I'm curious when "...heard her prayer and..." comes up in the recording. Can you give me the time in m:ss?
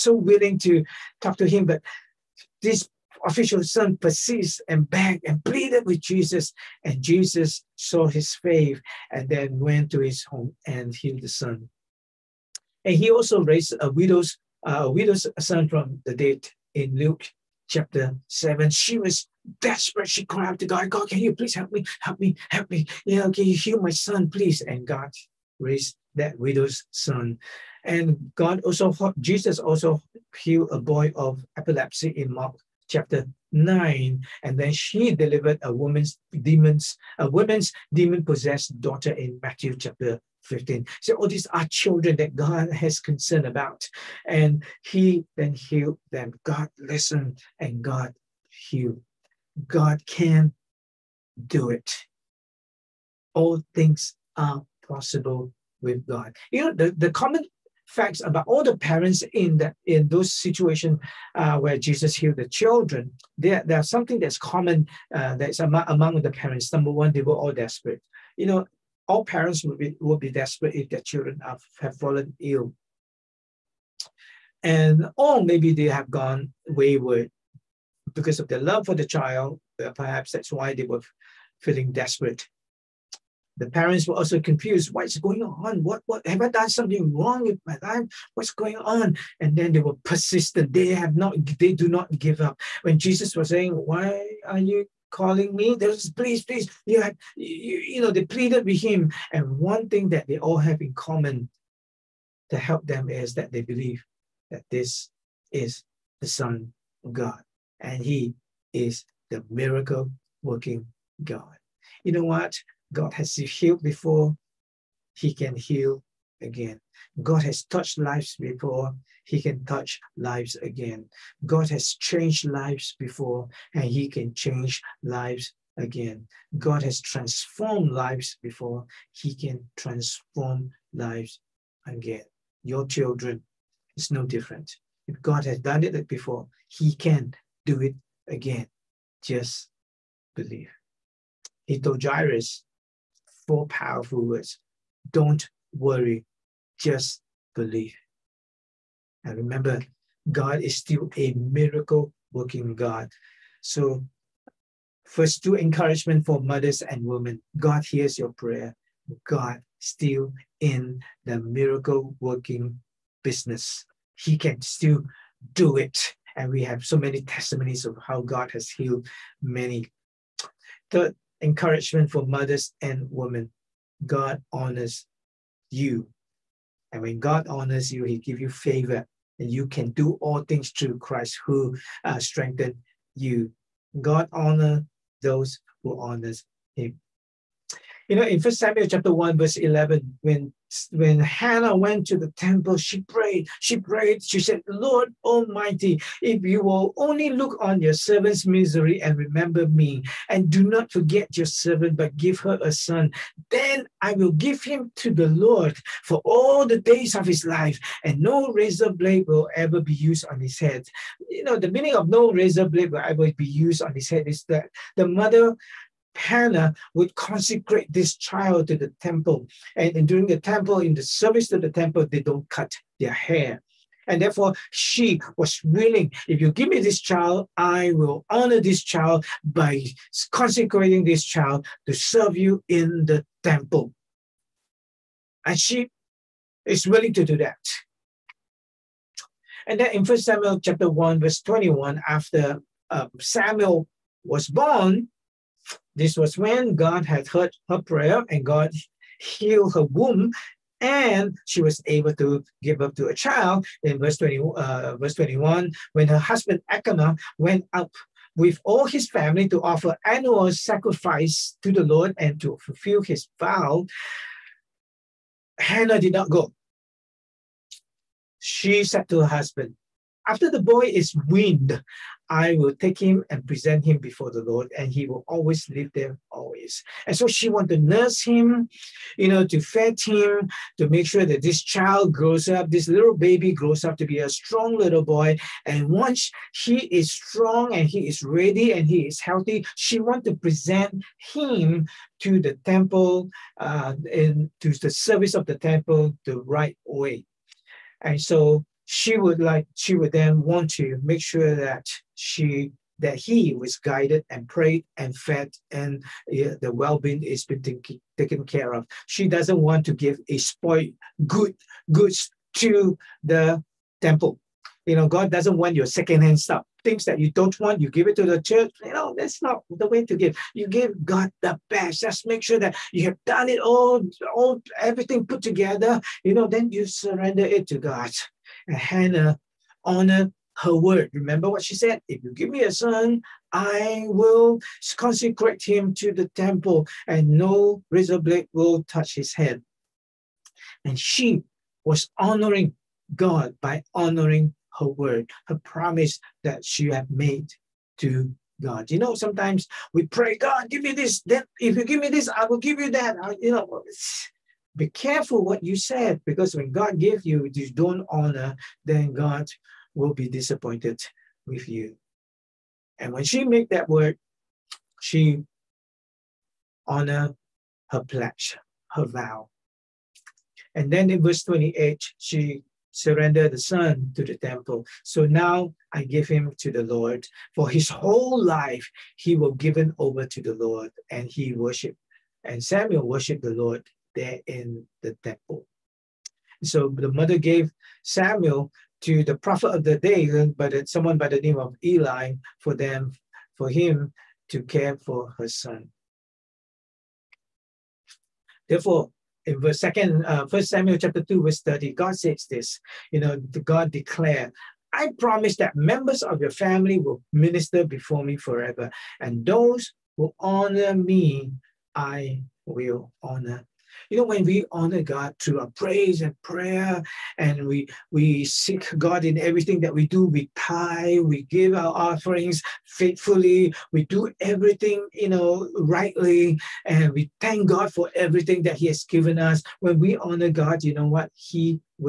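4:07.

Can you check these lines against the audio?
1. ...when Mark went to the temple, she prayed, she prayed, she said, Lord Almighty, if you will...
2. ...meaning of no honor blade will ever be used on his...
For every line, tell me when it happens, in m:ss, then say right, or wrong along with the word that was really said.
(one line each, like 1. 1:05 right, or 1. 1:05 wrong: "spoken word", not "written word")
1. 3:10 wrong: "Hannah", not "Mark"
2. 3:31 wrong: "razor", not "honor".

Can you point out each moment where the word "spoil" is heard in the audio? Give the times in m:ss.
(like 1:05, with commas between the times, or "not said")
5:10.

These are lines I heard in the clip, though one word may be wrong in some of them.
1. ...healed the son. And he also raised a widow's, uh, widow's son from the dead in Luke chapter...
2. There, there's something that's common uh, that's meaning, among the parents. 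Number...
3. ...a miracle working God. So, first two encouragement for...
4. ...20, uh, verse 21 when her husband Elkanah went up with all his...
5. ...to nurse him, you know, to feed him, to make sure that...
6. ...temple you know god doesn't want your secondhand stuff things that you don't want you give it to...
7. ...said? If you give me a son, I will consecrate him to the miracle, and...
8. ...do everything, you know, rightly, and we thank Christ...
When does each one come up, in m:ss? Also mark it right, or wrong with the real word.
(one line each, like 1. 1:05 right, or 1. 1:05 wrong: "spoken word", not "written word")
1. 0:10 right
2. 1:03 wrong: "among", not "meaning"
3. 2:31 right
4. 4:14 right
5. 4:37 right
6. 5:14 right
7. 5:31 wrong: "temple", not "miracle"
8. 7:04 wrong: "God", not "Christ".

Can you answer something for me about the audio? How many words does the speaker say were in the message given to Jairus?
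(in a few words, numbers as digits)
4.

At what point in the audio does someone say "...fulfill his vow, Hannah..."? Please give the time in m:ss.
4:22.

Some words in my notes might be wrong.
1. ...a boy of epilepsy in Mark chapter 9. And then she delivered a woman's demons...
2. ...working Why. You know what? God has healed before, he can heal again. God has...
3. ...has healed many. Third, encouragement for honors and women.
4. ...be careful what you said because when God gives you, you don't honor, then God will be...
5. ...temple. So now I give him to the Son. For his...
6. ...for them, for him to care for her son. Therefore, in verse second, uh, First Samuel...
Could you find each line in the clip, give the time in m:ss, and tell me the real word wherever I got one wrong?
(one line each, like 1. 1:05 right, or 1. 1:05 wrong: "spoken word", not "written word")
1. 0:30 right
2. 1:50 wrong: "God", not "Why"
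3. 2:48 wrong: "mothers", not "honors"
4. 5:54 right
5. 6:14 wrong: "Lord", not "Son"
6. 6:32 right.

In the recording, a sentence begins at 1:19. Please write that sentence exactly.
Perhaps that's why they were feeling desperate.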